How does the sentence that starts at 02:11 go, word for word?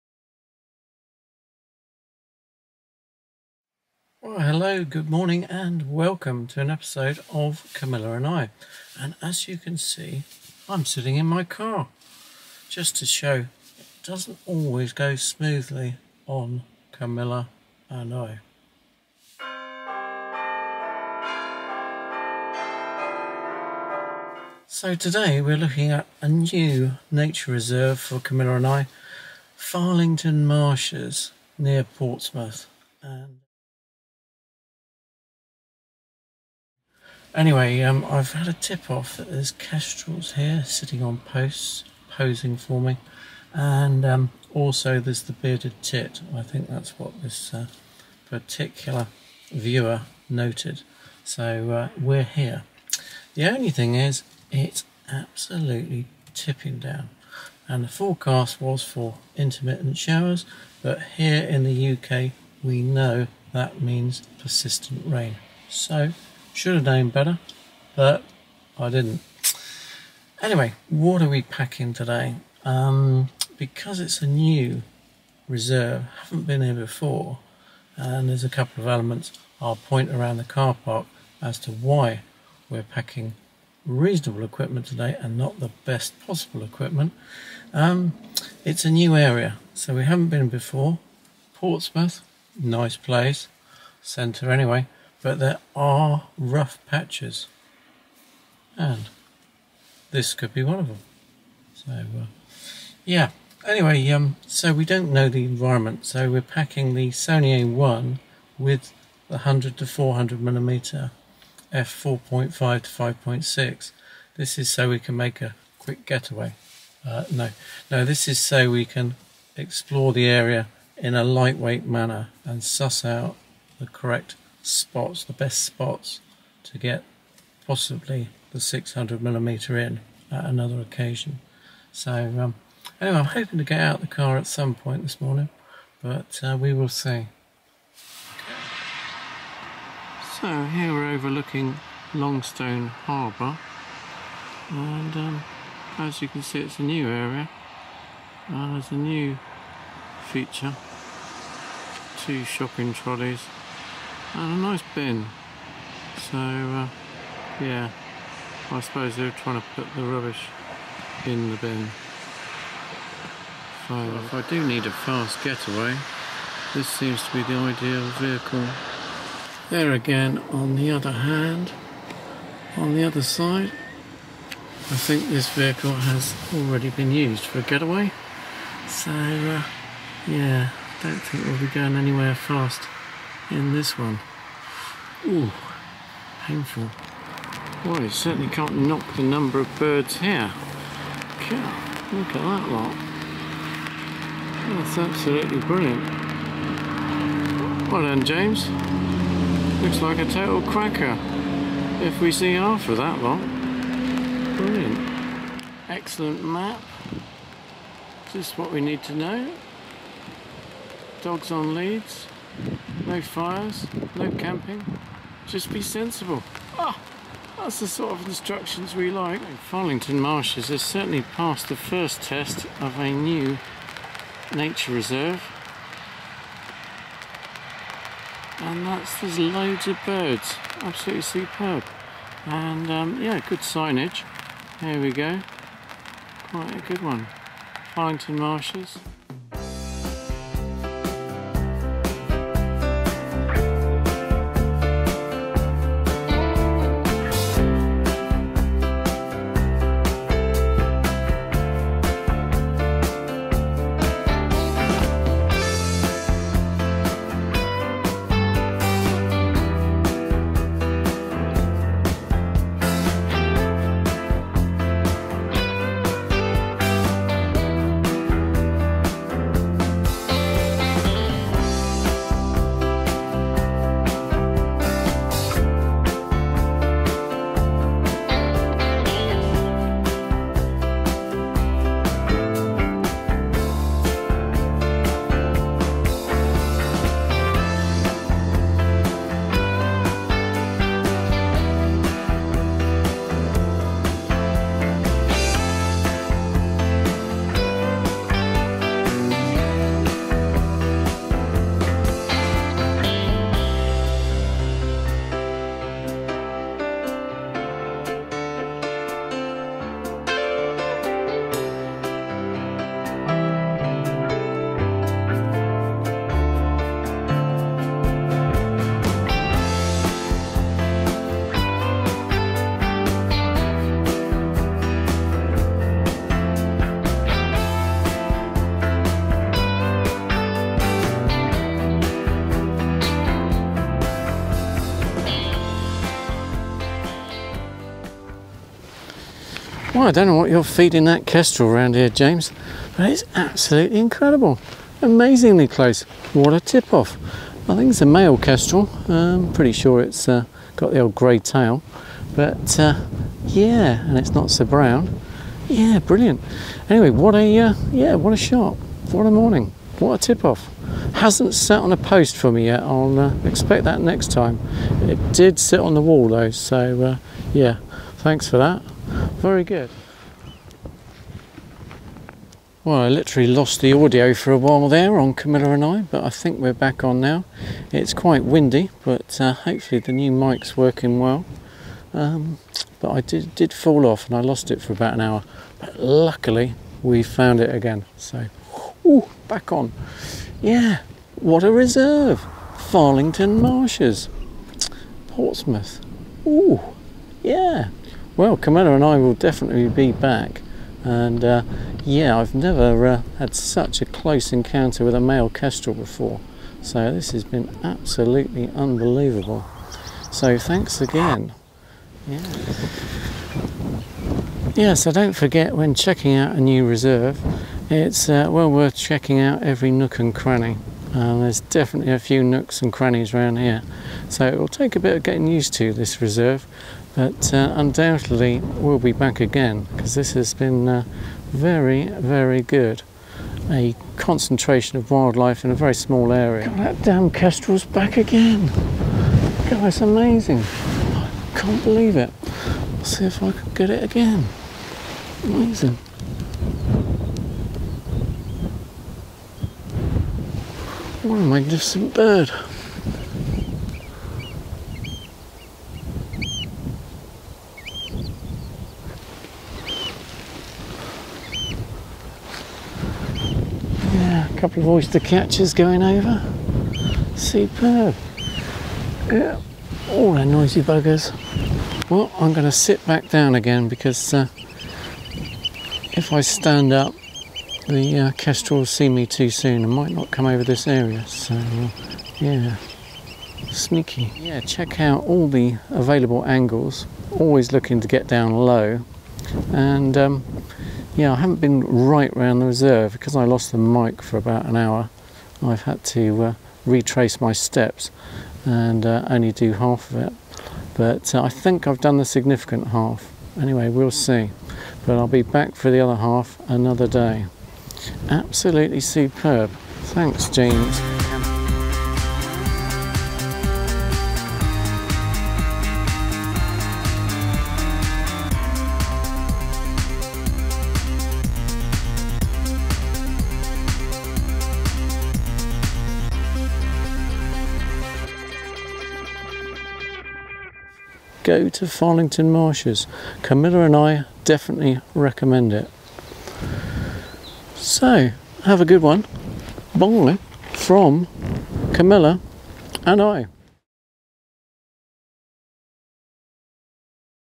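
So um, anyway, I'm hoping to get out the car at some point this morning, but uh, we will see.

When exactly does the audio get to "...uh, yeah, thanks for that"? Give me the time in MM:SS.
06:07.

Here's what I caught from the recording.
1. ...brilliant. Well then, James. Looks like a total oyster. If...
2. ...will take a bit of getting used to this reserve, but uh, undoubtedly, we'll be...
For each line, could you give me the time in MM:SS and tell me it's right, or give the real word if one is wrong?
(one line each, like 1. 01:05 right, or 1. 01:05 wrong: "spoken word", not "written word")
1. 03:15 wrong: "cracker", not "oyster"
2. 07:04 right.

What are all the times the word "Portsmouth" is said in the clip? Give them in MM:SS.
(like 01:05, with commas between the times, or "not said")
00:31, 01:31, 06:35.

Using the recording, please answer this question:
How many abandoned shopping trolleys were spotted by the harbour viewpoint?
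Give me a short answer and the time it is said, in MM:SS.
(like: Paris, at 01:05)
2, at 02:32.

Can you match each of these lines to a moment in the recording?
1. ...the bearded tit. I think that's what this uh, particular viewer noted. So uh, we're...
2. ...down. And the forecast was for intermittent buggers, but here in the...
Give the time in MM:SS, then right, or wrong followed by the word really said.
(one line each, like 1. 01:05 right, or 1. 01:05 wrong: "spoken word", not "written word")
1. 00:45 right
2. 00:56 wrong: "showers", not "buggers".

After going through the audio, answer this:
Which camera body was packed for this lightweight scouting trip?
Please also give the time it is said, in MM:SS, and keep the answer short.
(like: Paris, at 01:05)
Sony A1, at 01:47.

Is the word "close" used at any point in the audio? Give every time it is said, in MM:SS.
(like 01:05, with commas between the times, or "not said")
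05:45, 06:44.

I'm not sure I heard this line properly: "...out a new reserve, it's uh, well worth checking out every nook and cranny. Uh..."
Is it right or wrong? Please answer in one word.
right.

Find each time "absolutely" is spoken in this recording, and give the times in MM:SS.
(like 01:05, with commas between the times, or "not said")
00:55, 03:14, 03:50, 05:43, 06:47, 08:28.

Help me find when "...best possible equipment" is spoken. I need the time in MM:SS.
01:25.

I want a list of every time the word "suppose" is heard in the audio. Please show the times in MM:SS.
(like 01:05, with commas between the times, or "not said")
02:38.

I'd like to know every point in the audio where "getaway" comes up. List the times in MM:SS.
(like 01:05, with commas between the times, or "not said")
01:56, 02:45, 02:57.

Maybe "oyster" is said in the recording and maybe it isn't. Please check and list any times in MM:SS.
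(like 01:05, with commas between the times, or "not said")
07:44.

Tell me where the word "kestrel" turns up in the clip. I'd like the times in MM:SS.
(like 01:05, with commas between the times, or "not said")
00:39, 05:41, 05:48, 06:45, 07:17, 07:58.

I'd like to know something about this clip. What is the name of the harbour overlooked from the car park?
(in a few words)
Longstone Harbour.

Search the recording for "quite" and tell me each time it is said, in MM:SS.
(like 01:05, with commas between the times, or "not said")
03:56, 06:18.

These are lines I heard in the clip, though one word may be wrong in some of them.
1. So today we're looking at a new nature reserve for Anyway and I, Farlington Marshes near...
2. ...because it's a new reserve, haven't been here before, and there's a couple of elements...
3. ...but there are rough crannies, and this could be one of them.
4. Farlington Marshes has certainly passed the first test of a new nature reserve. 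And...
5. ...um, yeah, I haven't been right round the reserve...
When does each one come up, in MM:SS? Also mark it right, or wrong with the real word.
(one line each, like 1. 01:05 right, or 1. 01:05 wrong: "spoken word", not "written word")
1. 00:24 wrong: "Camilla", not "Anyway"
2. 01:13 right
3. 01:35 wrong: "patches", not "crannies"
4. 03:39 right
5. 08:10 right.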